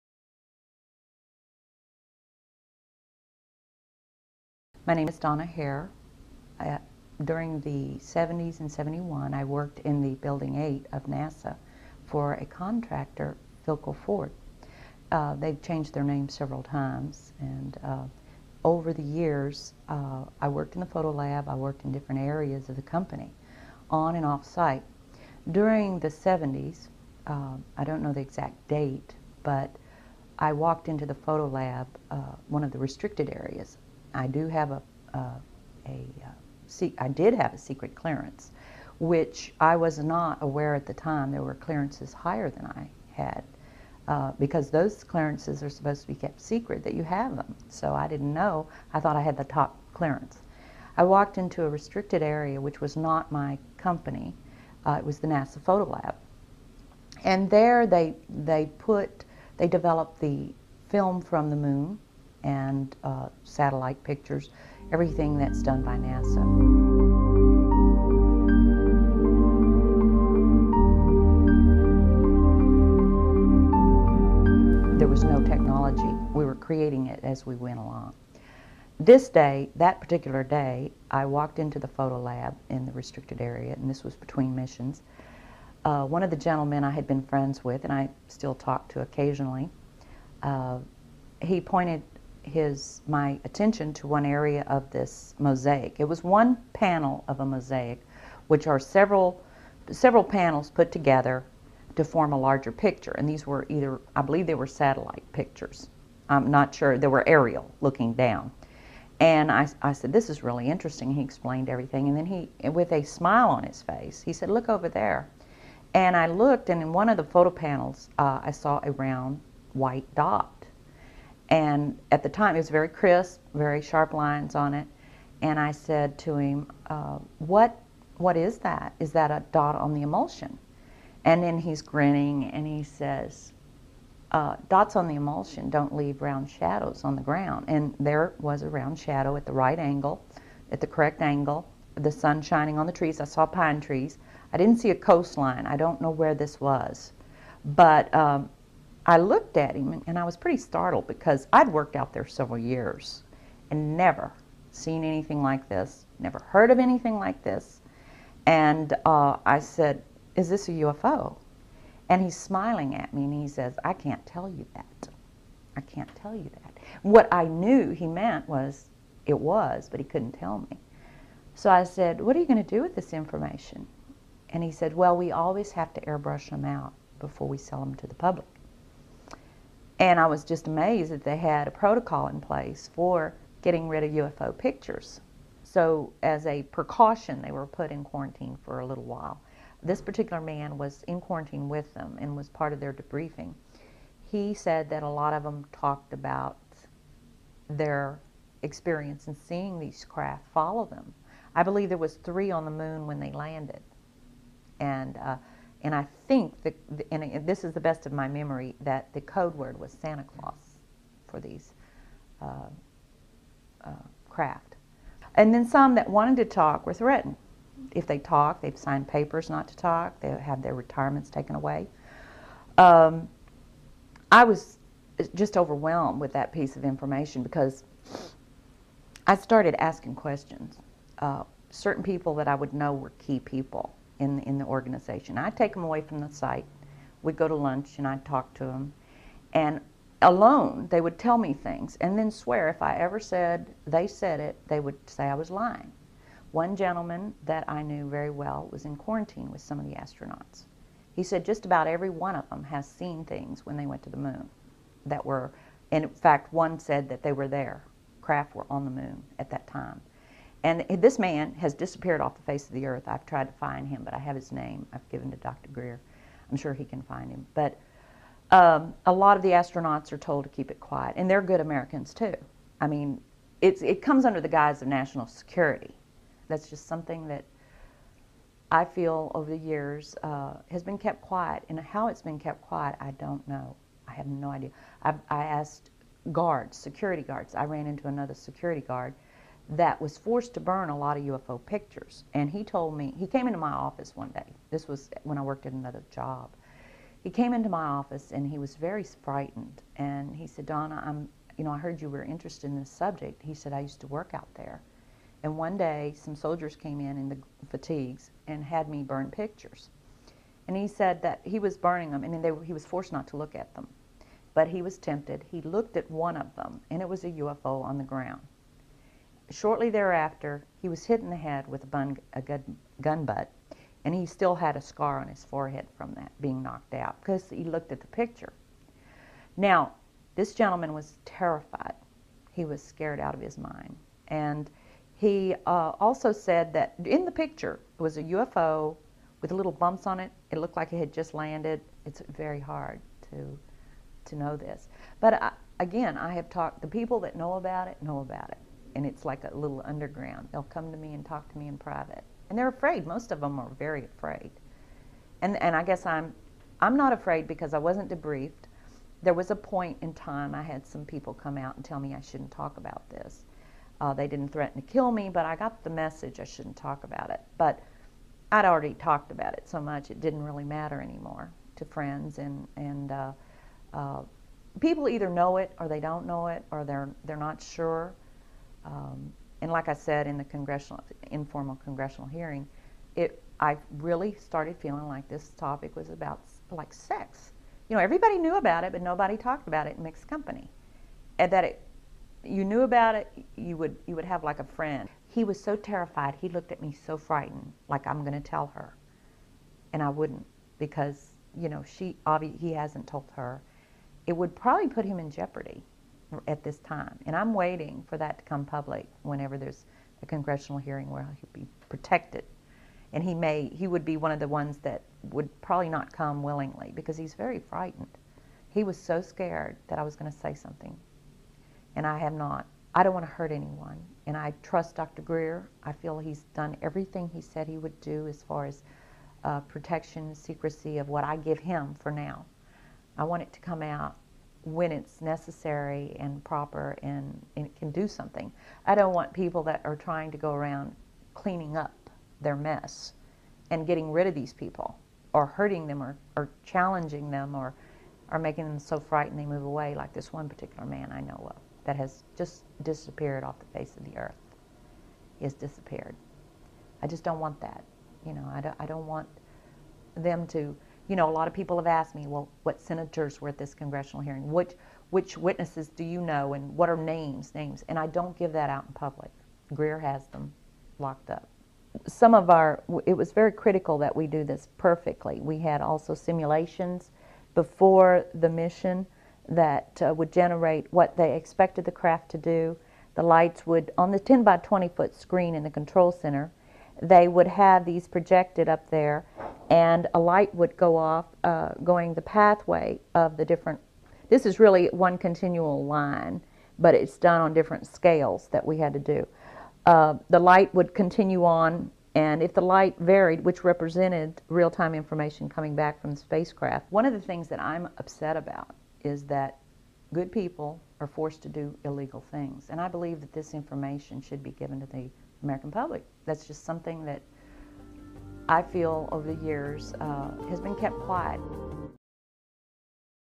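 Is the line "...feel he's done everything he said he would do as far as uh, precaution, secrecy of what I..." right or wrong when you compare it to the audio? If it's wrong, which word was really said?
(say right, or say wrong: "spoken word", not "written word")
wrong: "protection", not "precaution".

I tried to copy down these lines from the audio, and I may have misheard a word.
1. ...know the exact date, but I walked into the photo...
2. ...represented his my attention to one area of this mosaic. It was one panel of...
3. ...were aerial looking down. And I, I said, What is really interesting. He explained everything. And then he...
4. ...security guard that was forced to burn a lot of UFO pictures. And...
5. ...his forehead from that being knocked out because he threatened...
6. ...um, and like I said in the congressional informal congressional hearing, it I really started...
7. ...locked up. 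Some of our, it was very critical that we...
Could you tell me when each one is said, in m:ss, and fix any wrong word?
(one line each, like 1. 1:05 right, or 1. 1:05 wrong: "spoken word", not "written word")
1. 0:28 right
2. 1:31 wrong: "pointed", not "represented"
3. 1:47 wrong: "This", not "What"
4. 4:48 right
5. 5:25 wrong: "looked", not "threatened"
6. 6:18 right
7. 7:50 right.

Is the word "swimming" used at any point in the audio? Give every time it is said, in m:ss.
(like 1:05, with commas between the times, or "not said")
not said.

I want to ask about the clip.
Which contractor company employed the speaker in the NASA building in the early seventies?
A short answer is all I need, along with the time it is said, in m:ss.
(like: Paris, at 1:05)
Philco Ford, at 0:13.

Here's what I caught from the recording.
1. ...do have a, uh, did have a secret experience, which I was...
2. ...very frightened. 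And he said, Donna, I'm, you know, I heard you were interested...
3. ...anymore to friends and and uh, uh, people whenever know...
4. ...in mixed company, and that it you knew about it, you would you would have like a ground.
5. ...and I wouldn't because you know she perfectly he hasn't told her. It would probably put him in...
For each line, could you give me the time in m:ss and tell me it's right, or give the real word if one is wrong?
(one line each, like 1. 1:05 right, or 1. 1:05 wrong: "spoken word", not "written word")
1. 0:34 wrong: "clearance", not "experience"
2. 4:58 right
3. 6:11 wrong: "either", not "whenever"
4. 6:29 wrong: "friend", not "ground"
5. 6:39 wrong: "obviously", not "perfectly".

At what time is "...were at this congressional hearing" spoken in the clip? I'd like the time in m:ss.
7:43.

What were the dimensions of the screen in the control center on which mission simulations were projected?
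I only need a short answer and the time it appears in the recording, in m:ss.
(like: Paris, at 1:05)
10 by 20 feet, at 8:04.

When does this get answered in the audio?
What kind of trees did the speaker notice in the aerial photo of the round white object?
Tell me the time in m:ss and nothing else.
2:23.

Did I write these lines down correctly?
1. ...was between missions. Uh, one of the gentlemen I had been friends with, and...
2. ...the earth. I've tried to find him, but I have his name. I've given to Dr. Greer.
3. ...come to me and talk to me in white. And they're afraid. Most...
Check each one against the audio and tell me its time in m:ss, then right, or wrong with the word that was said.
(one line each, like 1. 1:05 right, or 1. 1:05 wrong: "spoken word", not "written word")
1. 1:24 right
2. 4:22 right
3. 5:50 wrong: "private", not "white".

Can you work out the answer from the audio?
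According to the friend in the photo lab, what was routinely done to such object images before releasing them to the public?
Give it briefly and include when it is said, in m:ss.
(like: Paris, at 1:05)
Airbrush them out, at 2:56.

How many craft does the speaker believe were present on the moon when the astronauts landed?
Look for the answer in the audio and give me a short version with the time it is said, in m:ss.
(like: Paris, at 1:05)
3, at 3:22.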